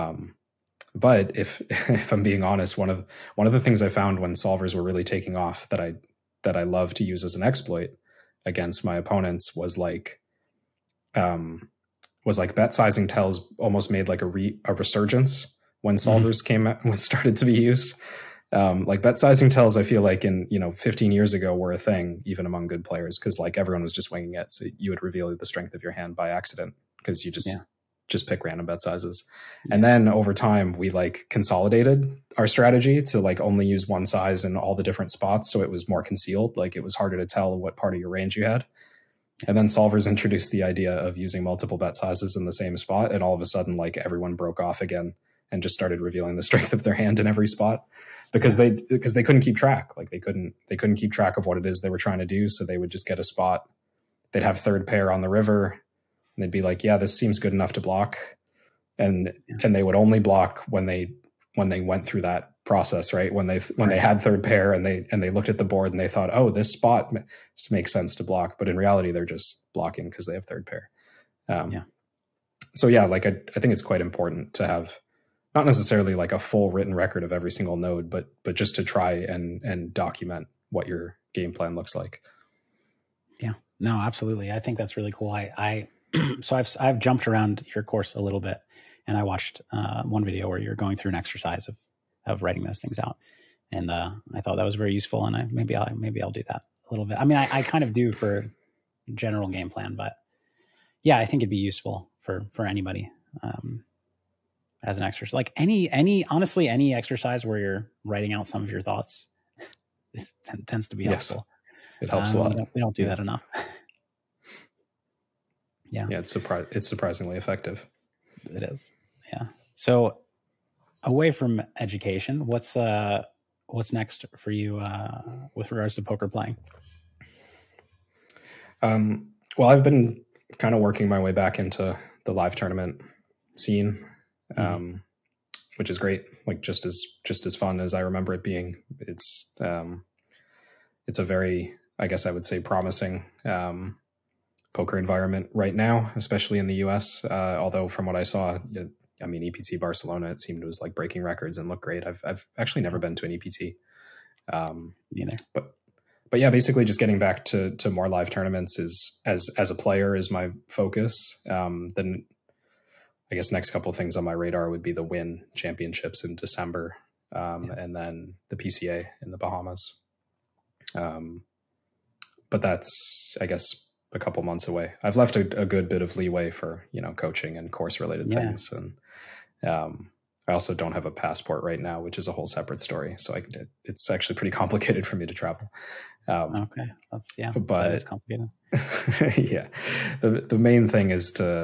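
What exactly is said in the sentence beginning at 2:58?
things, and um, I also don't have a passport right now, which is a whole separate story.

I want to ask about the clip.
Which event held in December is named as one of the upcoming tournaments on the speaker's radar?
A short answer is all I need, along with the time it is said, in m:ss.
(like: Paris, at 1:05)
Wynn Championships, at 2:45.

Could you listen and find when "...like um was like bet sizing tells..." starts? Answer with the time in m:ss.
0:09.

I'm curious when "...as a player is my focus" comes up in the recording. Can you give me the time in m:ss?
2:39.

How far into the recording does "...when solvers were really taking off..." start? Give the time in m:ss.
0:04.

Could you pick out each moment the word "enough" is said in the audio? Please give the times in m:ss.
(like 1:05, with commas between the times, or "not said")
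0:57, 1:53.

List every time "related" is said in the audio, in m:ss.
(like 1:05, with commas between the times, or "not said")
2:57.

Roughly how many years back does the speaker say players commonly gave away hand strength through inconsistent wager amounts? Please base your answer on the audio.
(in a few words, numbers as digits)
15 years.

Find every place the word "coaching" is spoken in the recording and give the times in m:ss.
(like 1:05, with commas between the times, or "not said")
2:57.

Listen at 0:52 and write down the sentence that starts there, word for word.
So they would just get a spot.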